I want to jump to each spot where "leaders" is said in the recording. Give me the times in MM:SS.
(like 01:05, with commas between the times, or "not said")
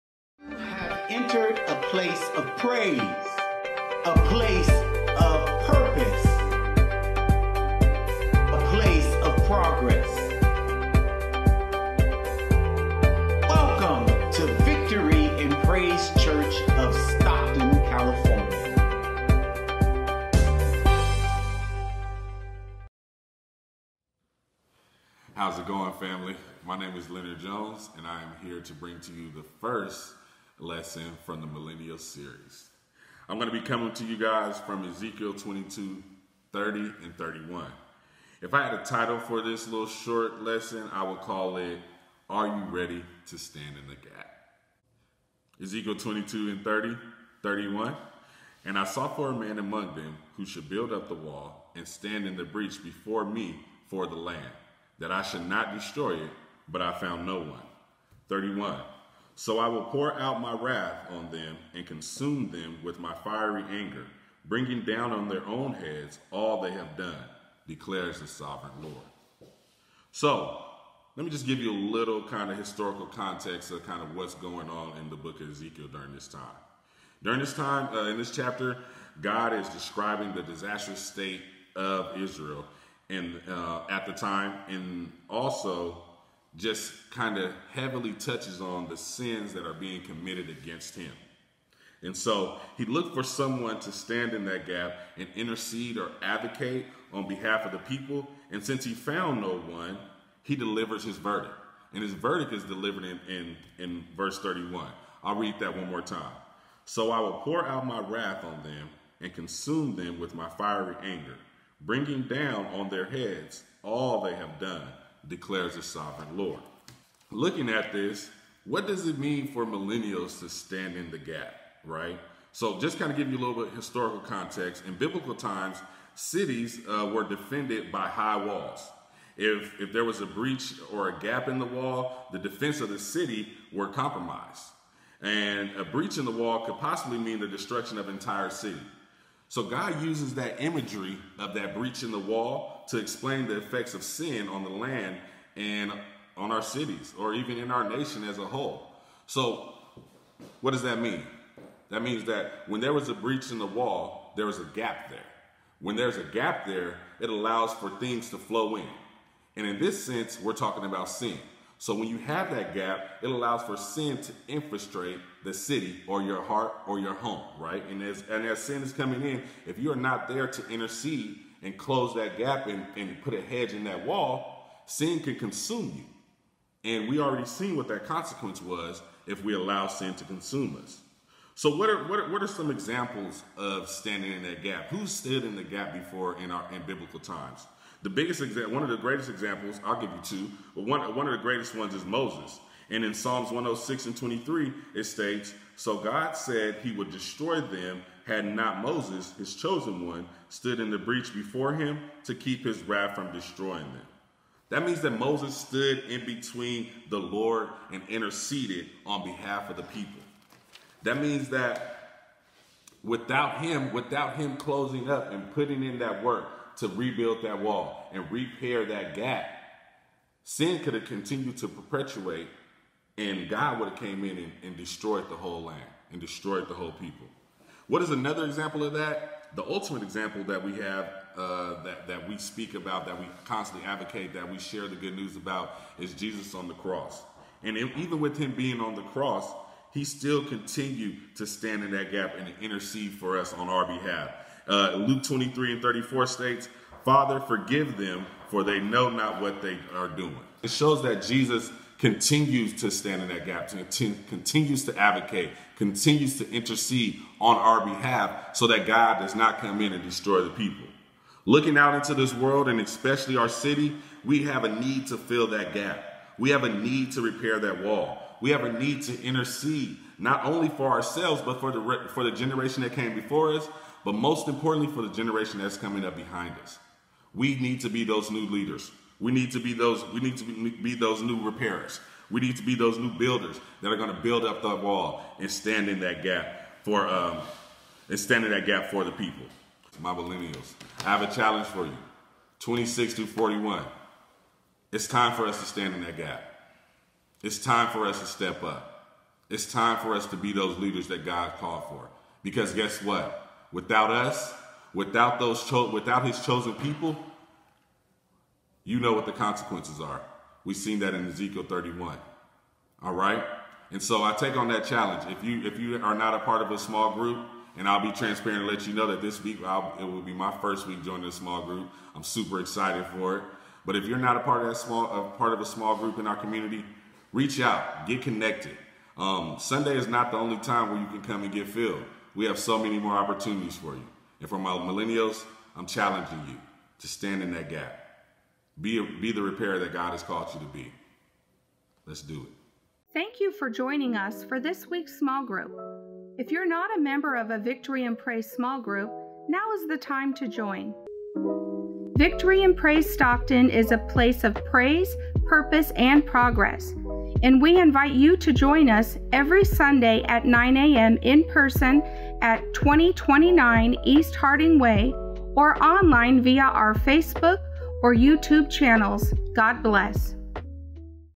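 04:38, 05:00.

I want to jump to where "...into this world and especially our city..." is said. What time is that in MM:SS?
04:21.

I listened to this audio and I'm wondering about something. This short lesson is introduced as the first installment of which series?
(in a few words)
Millennial Series.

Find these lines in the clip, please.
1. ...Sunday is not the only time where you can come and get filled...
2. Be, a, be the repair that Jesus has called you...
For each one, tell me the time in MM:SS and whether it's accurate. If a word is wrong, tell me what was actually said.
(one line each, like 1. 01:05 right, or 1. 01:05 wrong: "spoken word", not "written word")
1. 05:29 right
2. 05:38 wrong: "God", not "Jesus".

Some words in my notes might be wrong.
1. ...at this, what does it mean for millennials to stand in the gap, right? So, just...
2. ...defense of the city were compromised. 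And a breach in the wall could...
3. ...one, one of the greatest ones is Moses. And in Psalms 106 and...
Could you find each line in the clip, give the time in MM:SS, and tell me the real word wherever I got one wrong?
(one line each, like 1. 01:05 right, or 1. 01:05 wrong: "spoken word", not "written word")
1. 01:57 right
2. 02:12 right
3. 03:10 right.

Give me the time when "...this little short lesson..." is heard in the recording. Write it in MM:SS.
00:39.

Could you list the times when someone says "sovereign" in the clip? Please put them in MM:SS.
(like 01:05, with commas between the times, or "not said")
01:08, 01:55.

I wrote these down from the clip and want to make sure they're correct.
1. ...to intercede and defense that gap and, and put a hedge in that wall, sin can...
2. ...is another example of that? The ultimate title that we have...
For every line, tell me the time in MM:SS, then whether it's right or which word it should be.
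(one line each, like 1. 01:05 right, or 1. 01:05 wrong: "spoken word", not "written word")
1. 02:50 wrong: "close", not "defense"
2. 03:48 wrong: "example", not "title".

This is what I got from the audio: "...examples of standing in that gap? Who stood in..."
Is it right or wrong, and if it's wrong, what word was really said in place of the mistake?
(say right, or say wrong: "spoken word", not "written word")
right.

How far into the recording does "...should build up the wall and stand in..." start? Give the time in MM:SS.
00:50.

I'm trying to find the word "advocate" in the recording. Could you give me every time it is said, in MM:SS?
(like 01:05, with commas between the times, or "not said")
01:36, 03:53, 04:14.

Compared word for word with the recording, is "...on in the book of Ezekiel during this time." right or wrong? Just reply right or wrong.
right.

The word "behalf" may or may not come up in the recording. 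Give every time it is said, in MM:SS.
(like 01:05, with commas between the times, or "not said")
01:37, 03:29, 04:03, 04:17.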